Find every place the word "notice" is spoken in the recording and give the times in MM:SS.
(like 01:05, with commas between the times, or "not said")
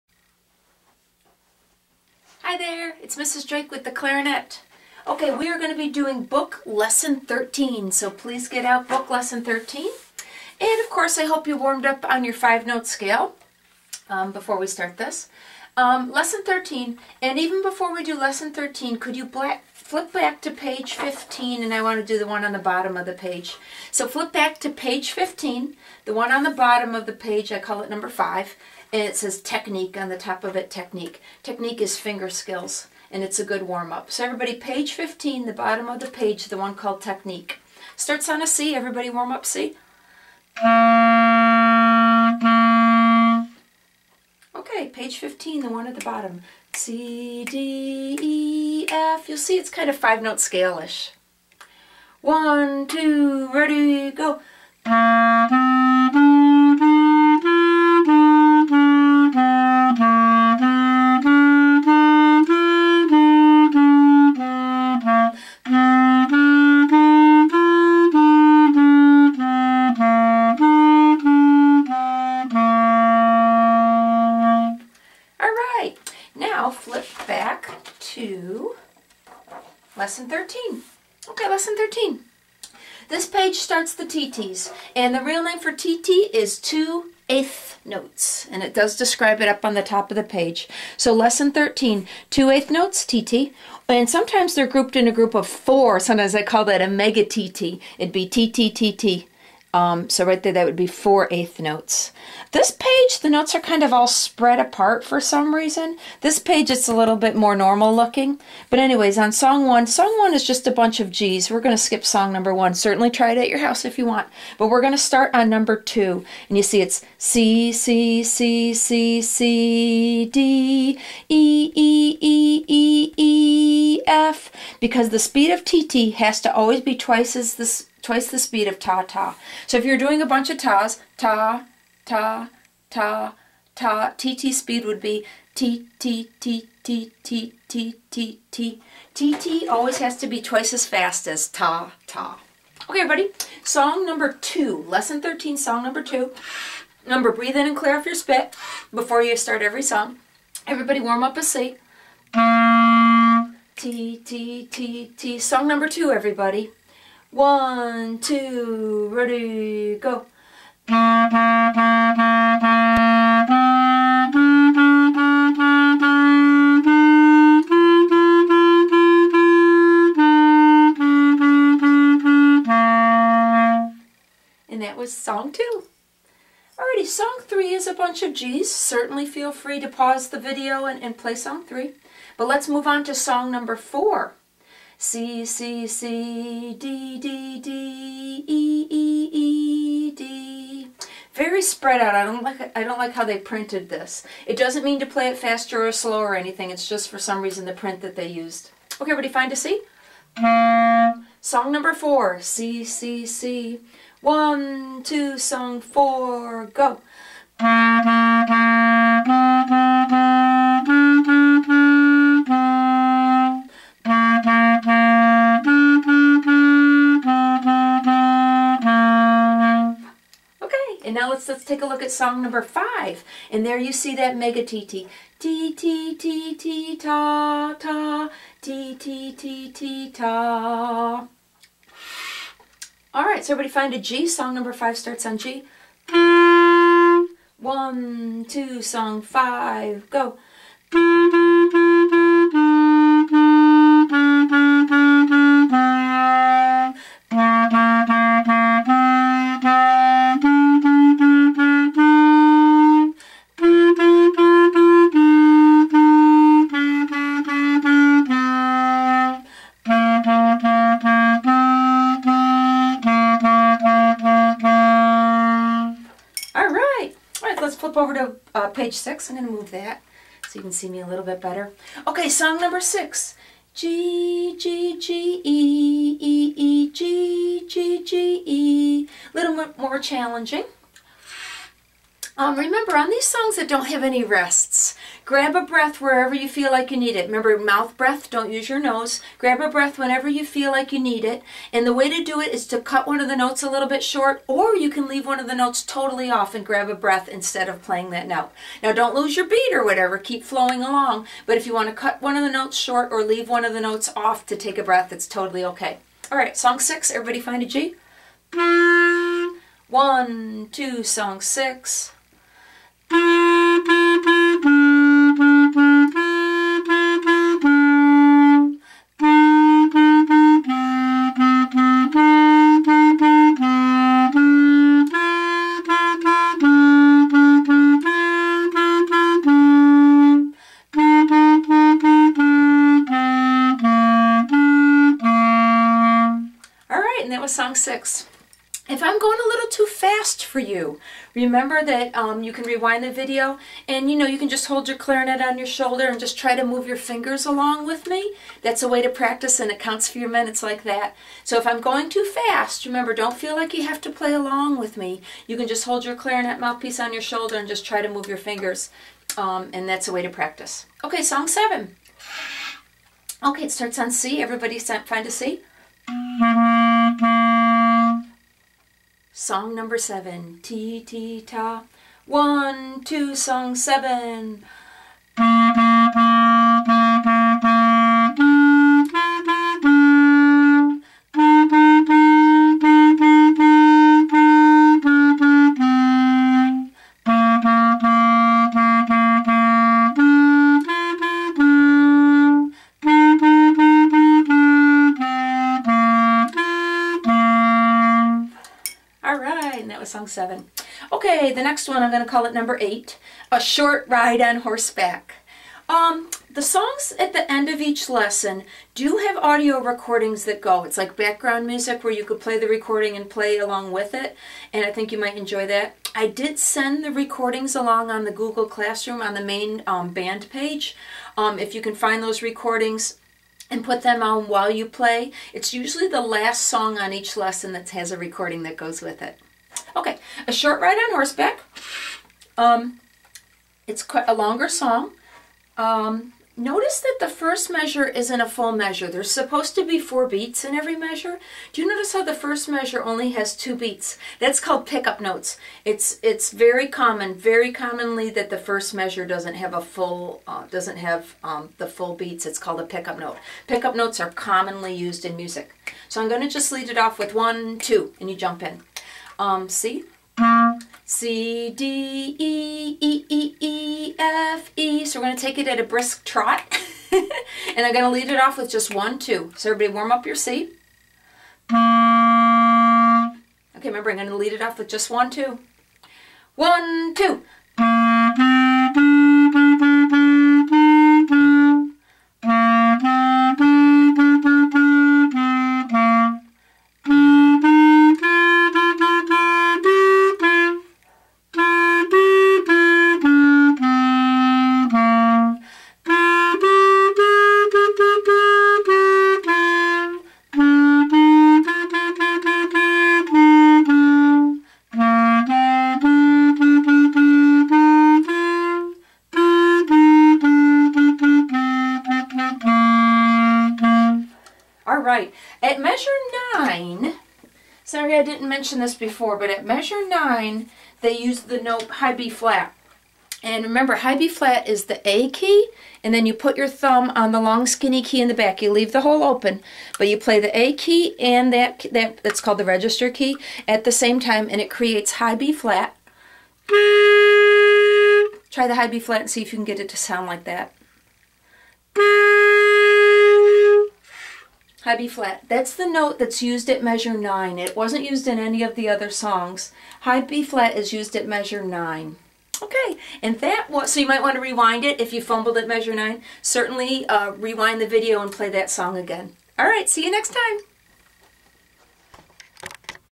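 07:16, 07:21.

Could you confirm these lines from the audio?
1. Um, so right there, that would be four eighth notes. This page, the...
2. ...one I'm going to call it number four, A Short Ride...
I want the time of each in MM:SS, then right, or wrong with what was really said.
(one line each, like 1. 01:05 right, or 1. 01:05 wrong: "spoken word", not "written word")
1. 01:39 right
2. 06:41 wrong: "eight", not "four".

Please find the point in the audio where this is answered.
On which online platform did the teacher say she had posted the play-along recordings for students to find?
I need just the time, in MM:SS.
06:58.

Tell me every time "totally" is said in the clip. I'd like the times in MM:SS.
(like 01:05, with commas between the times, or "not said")
04:55, 05:05.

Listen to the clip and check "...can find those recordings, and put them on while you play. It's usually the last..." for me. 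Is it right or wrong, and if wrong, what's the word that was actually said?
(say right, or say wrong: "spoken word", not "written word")
right.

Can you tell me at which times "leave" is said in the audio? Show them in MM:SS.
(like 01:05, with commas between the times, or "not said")
04:55, 05:03, 08:48.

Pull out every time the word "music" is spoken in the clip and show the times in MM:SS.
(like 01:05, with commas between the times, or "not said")
06:51, 07:35.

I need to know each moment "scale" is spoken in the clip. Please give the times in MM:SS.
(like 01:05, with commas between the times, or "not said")
00:12, 00:50.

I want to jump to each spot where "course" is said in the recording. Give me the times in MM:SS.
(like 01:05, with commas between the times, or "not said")
00:10.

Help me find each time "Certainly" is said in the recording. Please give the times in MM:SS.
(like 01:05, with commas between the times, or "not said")
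01:52, 02:58, 09:16.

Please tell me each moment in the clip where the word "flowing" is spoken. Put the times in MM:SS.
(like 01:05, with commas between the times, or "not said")
05:00.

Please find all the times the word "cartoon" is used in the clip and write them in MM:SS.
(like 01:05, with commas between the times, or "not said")
not said.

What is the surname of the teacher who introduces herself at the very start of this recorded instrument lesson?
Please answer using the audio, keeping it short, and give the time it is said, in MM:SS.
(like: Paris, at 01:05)
Drake, at 00:03.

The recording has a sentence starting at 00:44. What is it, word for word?
Okay, page 15, the one at the bottom.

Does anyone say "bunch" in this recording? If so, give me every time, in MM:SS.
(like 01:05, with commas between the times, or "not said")
01:50, 02:10, 02:57.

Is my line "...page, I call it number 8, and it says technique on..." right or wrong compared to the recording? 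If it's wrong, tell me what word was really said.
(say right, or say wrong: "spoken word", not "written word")
wrong: "5", not "8".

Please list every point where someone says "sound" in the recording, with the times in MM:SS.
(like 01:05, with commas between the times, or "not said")
08:59.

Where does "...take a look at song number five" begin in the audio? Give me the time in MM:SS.
03:41.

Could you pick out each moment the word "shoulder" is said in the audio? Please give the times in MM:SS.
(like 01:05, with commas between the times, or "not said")
05:45, 05:57.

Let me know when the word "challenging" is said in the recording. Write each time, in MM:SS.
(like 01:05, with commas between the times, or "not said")
04:39.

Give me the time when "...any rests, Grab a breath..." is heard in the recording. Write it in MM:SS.
04:44.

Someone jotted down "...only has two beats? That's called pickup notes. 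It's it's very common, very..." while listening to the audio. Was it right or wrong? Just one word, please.
right.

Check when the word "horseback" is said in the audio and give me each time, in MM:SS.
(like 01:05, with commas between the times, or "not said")
06:44, 07:11.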